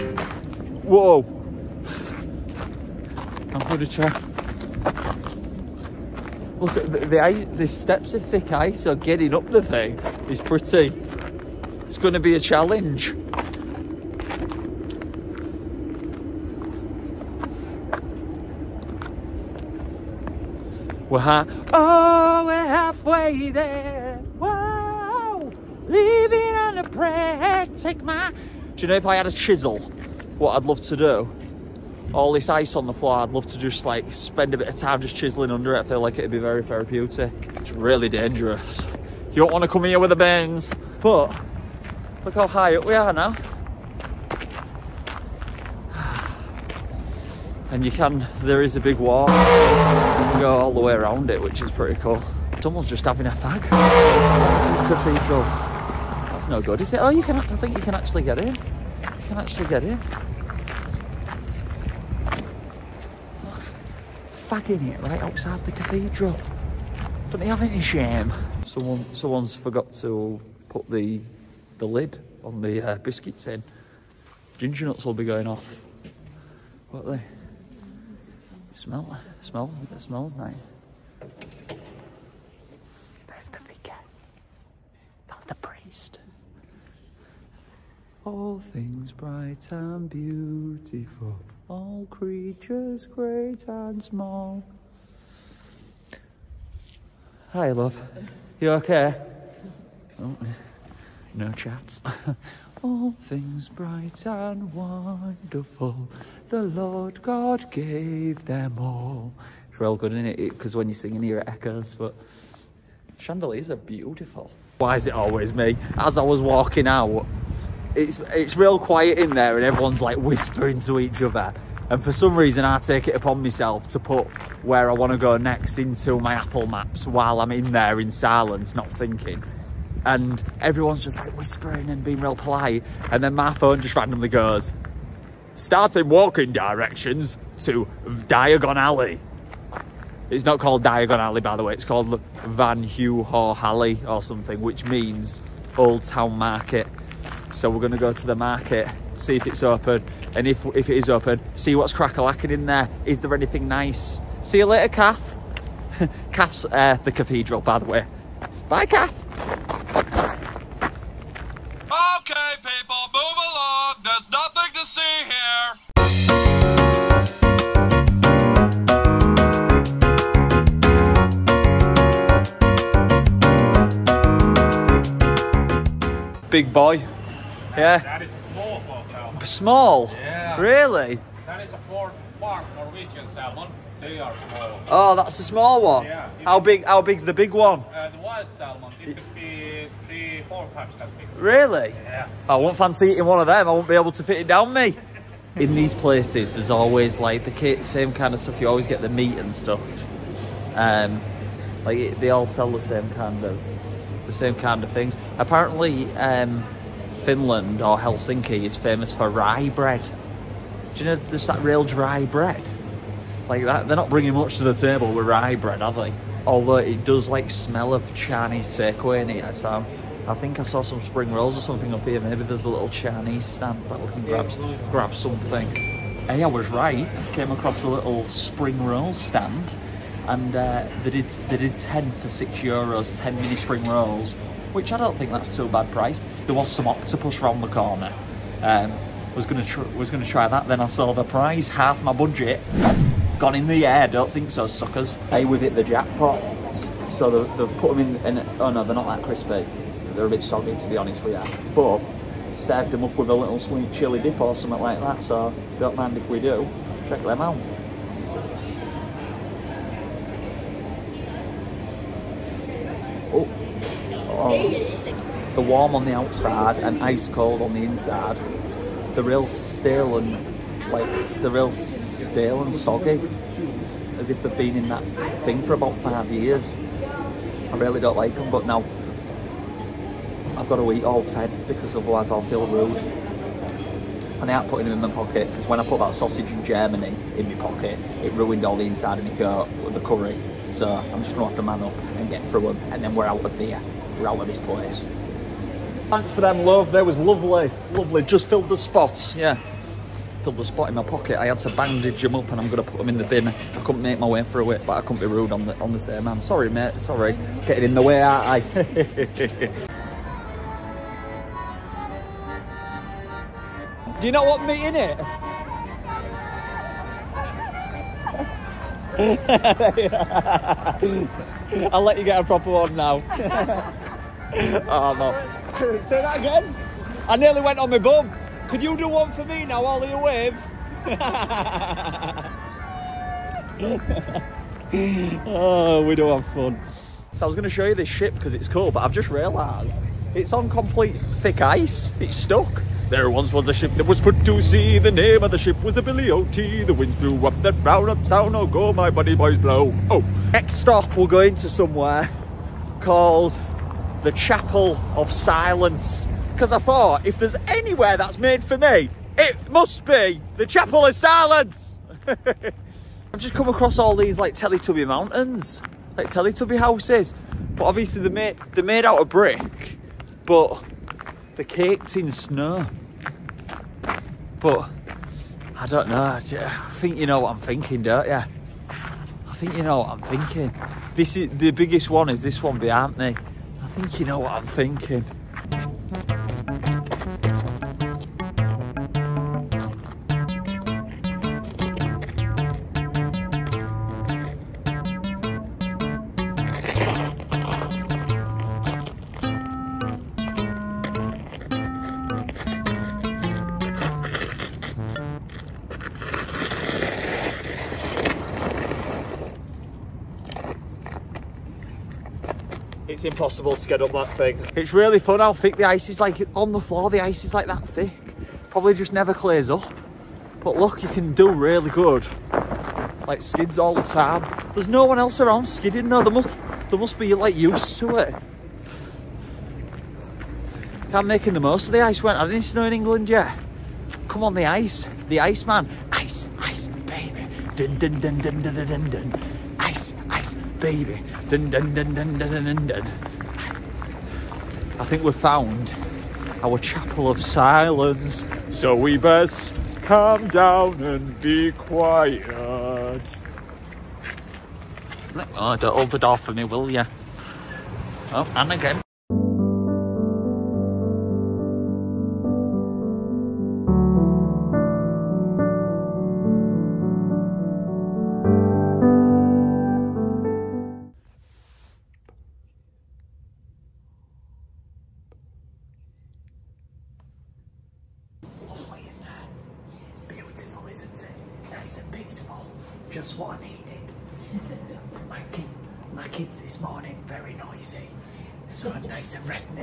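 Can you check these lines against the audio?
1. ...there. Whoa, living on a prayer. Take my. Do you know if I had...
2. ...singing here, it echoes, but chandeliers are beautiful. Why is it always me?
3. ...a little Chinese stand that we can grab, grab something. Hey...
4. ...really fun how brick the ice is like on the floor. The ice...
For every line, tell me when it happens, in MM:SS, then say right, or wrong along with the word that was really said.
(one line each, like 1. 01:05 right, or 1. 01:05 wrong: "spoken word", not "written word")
1. 00:23 right
2. 01:50 right
3. 03:42 right
4. 06:54 wrong: "thick", not "brick".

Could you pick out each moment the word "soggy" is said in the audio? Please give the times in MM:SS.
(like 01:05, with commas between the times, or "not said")
04:10, 04:32.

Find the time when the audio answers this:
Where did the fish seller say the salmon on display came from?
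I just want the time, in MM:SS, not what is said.
03:02.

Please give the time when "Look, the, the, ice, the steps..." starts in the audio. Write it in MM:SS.
00:06.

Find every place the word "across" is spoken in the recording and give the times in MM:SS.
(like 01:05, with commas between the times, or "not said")
03:47, 06:03.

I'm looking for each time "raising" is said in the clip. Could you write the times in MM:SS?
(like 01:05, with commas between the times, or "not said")
not said.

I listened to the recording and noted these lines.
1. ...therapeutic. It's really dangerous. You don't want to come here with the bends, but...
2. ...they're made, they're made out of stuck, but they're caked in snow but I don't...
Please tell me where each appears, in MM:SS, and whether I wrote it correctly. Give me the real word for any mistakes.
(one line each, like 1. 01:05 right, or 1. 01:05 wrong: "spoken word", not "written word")
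1. 00:36 right
2. 06:08 wrong: "brick", not "stuck".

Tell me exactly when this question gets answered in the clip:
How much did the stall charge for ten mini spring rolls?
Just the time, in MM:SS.
03:52.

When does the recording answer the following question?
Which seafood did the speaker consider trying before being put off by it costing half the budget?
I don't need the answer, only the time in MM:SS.
03:56.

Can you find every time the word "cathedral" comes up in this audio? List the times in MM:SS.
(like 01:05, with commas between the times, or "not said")
00:54, 01:05, 02:37.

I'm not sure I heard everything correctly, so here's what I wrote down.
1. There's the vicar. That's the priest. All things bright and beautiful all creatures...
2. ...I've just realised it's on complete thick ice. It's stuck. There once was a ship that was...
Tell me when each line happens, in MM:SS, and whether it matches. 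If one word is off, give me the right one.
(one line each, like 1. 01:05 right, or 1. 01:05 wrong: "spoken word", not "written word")
1. 01:23 right
2. 05:39 right.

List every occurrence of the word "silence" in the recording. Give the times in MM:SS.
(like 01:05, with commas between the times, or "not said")
02:08, 05:55, 06:01, 07:27.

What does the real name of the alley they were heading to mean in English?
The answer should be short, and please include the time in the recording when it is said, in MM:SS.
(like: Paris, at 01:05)
Old Town Market, at 02:25.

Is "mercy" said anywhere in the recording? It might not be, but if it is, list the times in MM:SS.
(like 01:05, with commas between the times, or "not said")
not said.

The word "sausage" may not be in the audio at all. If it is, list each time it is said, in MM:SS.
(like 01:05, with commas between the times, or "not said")
04:46.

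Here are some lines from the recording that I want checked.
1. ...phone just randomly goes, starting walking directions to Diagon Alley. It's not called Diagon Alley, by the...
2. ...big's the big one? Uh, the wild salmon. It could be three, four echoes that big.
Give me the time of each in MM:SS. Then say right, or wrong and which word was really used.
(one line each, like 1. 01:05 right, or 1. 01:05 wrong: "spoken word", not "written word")
1. 02:13 right
2. 03:07 wrong: "times", not "echoes".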